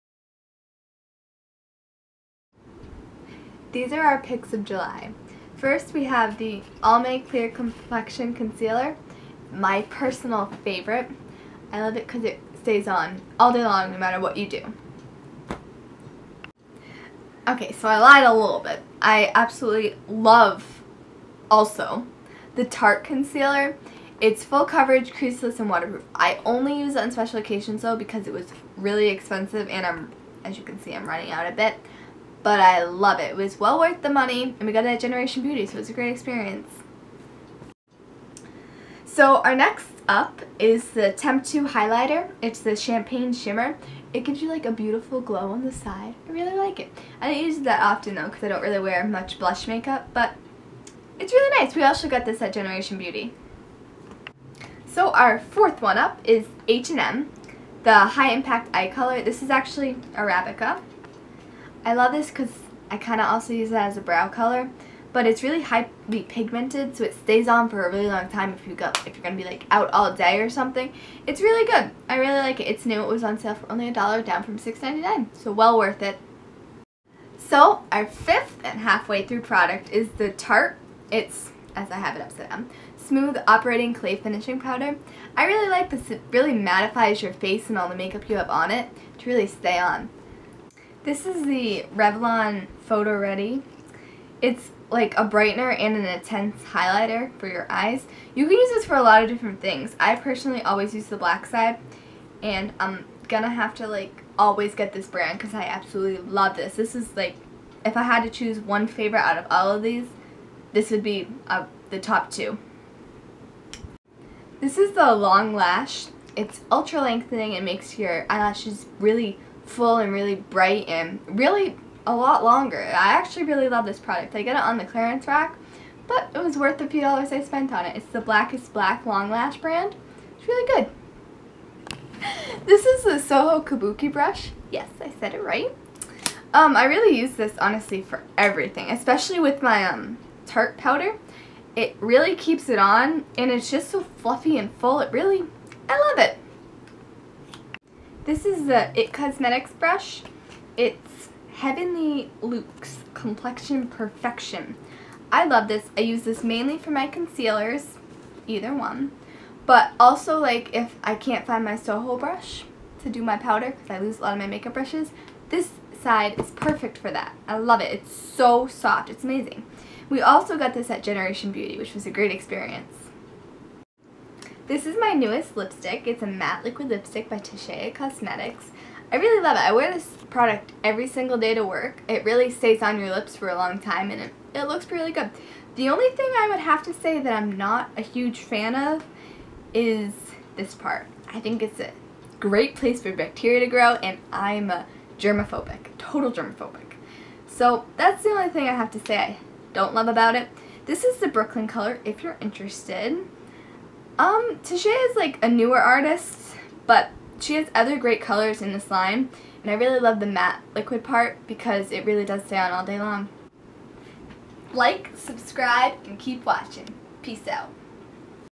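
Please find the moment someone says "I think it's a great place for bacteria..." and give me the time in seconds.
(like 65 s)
191 s.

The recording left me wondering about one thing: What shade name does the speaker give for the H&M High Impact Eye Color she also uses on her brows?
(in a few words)
Arabica.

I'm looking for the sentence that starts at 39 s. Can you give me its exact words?
So our next up is the Temptu highlighter.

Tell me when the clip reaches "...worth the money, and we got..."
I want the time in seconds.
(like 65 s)
33 s.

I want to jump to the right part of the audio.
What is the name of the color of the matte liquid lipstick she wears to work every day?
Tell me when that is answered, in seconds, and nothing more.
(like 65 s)
201 s.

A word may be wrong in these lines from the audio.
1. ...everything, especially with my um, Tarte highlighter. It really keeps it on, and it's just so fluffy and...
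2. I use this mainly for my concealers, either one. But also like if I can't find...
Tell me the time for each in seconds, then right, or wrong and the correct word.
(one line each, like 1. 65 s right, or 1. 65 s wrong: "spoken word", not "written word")
1. 138 s wrong: "powder", not "highlighter"
2. 155 s right.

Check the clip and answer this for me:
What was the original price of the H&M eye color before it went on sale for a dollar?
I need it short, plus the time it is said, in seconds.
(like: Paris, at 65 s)
$6.99, at 74 s.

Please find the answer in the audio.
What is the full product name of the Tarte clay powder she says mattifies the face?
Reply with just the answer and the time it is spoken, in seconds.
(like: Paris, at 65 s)
Smooth Operating Clay Finishing Powder, at 82 s.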